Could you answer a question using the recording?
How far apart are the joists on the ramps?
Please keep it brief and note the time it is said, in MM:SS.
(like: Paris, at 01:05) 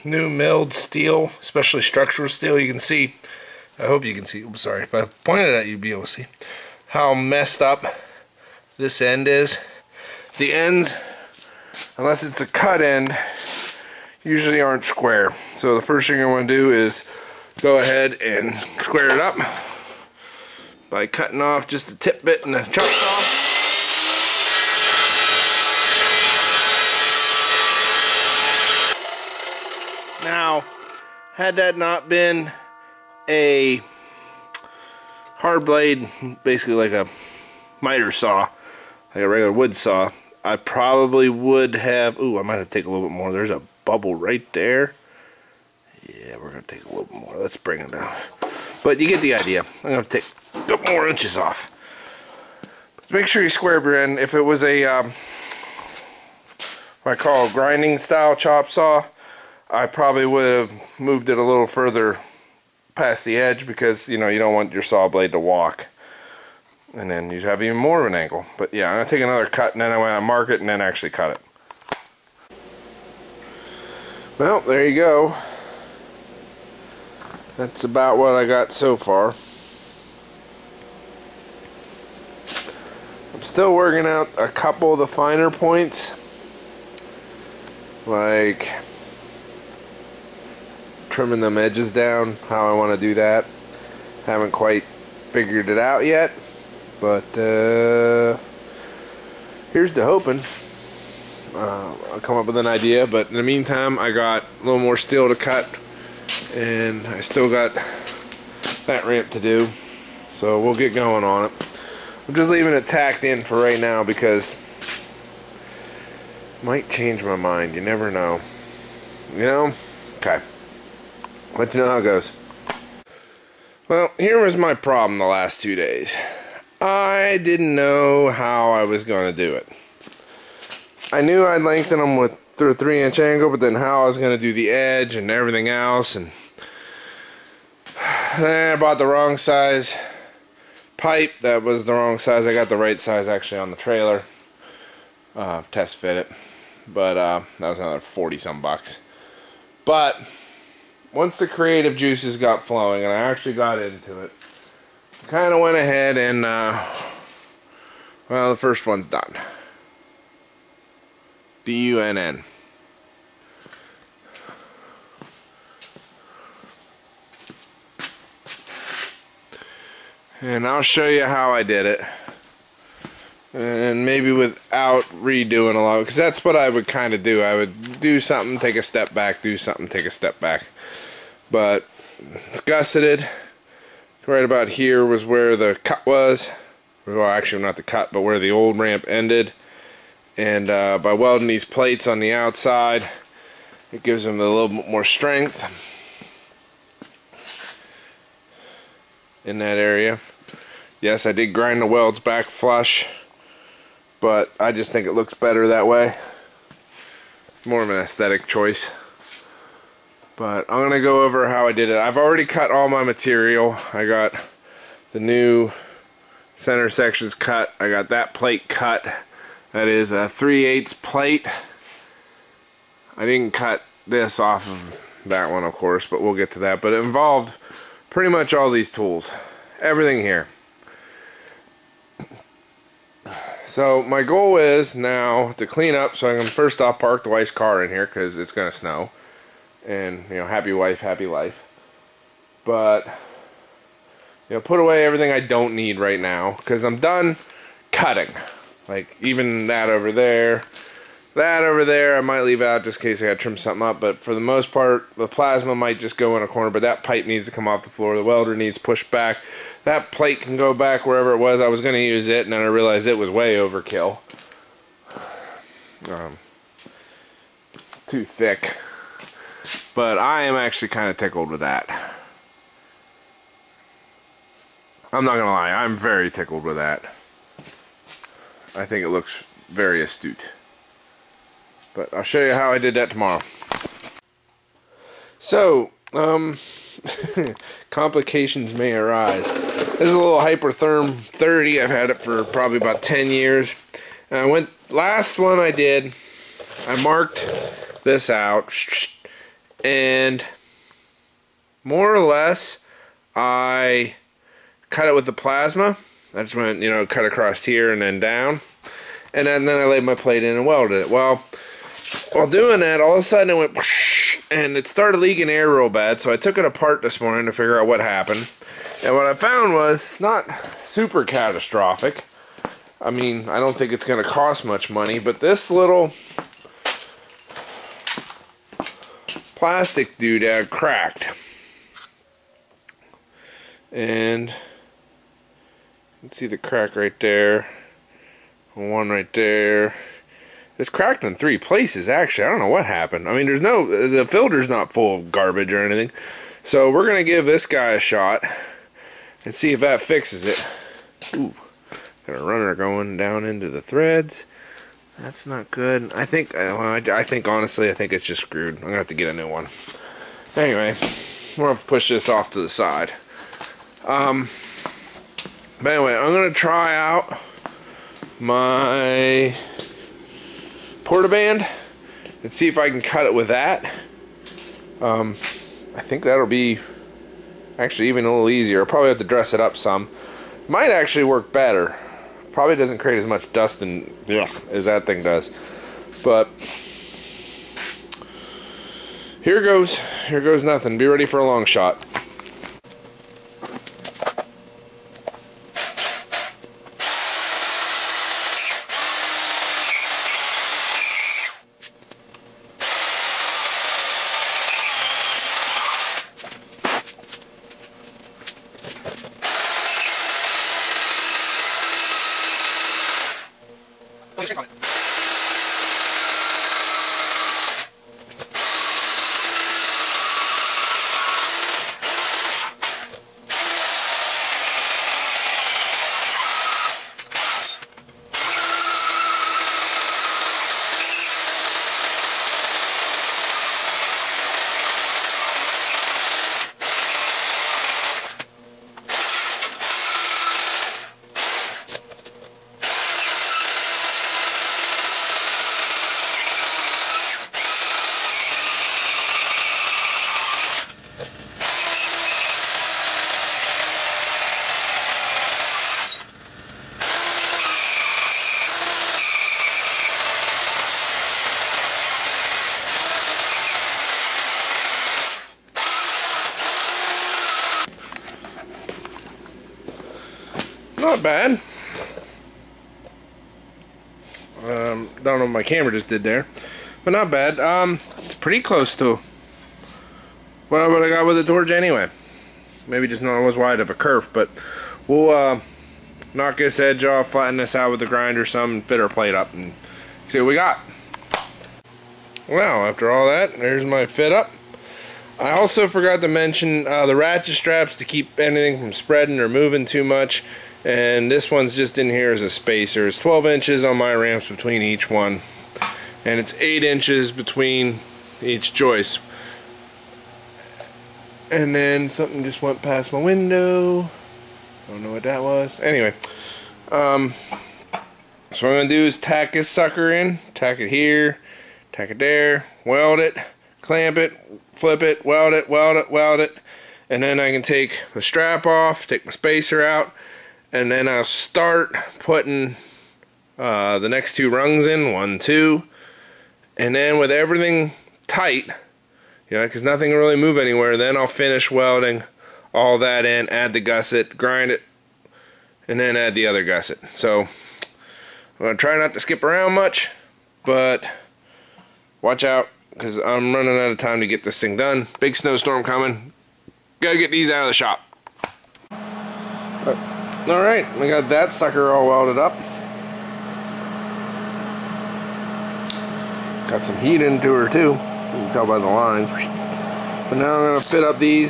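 8 inches, at 08:26.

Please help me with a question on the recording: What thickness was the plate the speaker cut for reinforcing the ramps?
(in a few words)
3/8.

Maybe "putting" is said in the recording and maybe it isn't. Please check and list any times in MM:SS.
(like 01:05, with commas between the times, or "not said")
08:52.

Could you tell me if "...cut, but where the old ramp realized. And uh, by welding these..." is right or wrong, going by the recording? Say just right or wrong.
wrong.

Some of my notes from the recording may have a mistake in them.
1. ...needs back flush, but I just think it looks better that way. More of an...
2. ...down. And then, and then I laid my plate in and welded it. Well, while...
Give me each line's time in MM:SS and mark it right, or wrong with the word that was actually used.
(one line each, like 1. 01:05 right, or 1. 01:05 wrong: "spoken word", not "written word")
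1. 03:21 wrong: "welds", not "needs"
2. 05:08 right.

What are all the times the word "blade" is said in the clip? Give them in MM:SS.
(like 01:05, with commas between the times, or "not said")
00:35, 01:05.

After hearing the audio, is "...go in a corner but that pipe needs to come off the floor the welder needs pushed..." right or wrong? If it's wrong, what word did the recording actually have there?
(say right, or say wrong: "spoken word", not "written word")
right.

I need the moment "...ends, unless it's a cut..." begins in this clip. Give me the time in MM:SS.
00:10.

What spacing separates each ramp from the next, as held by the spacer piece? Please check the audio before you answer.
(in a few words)
12 inches.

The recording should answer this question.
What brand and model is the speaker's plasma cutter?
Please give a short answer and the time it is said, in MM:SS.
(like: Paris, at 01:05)
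Hypertherm 30, at 04:50.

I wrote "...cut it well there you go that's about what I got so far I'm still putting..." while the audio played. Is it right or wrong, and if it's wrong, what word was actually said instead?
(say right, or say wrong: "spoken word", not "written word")
wrong: "working", not "putting".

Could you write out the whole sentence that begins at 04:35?
I'm not going to lie, I'm very tickled with that.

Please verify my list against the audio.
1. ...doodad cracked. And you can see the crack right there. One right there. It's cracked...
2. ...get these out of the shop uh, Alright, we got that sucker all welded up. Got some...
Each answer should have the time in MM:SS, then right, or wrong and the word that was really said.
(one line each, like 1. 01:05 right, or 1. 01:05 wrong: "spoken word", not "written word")
1. 05:30 right
2. 09:17 right.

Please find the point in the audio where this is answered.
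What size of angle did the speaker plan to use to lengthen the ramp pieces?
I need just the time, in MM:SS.
02:12.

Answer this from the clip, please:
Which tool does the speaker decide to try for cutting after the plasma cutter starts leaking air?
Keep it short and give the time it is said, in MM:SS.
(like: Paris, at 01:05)
Portaband, at 06:11.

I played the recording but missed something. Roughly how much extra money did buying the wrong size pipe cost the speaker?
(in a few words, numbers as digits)
40 some bucks.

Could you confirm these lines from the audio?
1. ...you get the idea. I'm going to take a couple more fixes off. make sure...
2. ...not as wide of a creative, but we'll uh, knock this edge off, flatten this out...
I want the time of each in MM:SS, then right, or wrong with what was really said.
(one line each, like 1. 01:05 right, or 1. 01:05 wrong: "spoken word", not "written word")
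1. 00:49 wrong: "inches", not "fixes"
2. 08:03 wrong: "curve", not "creative".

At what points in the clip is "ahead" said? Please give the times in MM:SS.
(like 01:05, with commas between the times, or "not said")
00:17, 02:35.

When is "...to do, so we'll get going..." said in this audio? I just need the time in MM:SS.
01:49.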